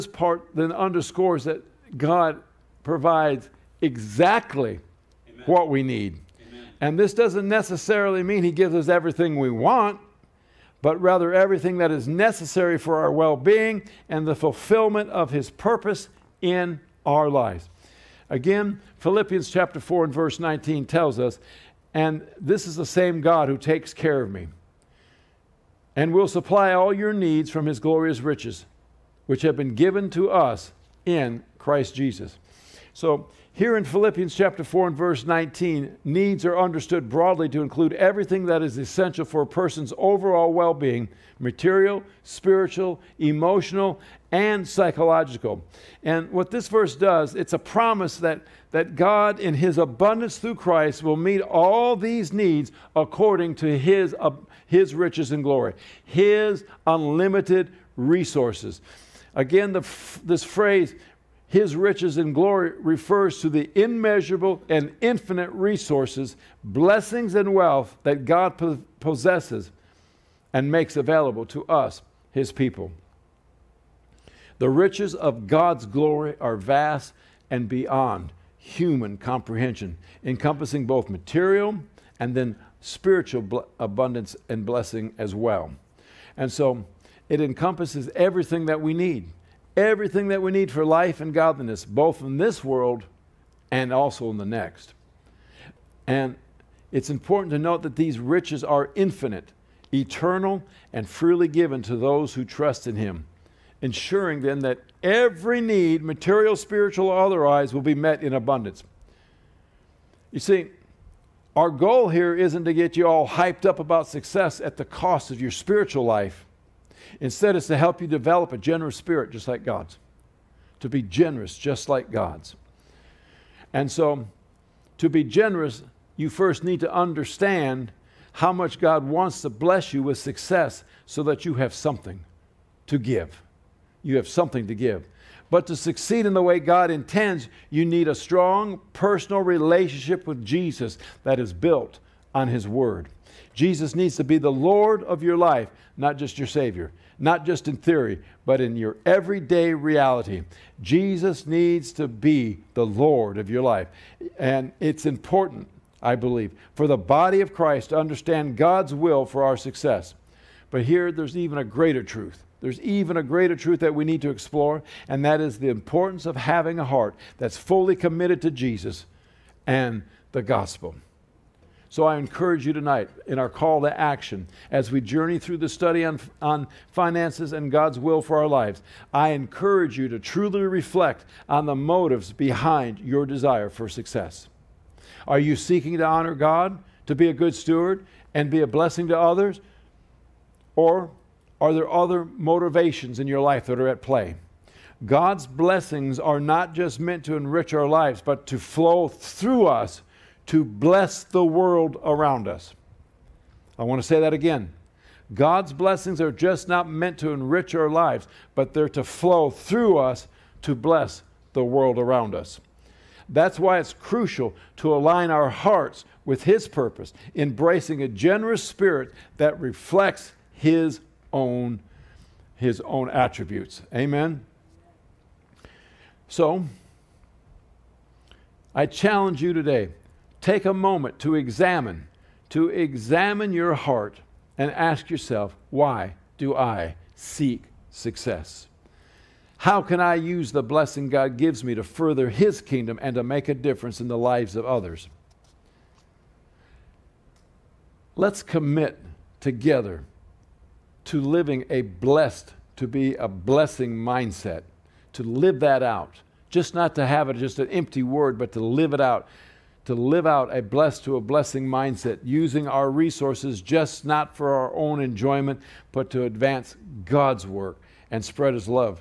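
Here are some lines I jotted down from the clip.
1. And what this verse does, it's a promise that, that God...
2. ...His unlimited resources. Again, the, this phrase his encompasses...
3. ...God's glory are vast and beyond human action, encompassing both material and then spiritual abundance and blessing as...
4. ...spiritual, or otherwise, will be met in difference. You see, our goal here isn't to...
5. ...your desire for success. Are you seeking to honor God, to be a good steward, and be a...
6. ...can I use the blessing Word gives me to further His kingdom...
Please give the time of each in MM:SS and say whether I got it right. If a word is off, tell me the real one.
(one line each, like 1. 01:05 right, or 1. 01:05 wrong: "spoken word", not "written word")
1. 00:46 right
2. 00:56 wrong: "riches", not "encompasses"
3. 01:15 wrong: "comprehension", not "action"
4. 01:46 wrong: "abundance", not "difference"
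5. 03:02 right
6. 03:59 wrong: "God", not "Word".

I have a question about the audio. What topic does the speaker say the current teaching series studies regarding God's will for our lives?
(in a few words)
Finances.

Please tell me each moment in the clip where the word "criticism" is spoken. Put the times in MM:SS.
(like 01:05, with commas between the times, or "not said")
not said.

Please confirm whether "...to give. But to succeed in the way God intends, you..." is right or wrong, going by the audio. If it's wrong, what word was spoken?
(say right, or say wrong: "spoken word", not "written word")
right.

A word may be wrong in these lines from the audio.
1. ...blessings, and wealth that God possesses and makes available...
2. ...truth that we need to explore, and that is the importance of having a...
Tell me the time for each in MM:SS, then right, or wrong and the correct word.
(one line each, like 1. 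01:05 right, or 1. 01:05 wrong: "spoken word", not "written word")
1. 01:06 right
2. 02:43 right.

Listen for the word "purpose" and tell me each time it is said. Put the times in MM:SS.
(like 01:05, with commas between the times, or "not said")
00:15, 03:36.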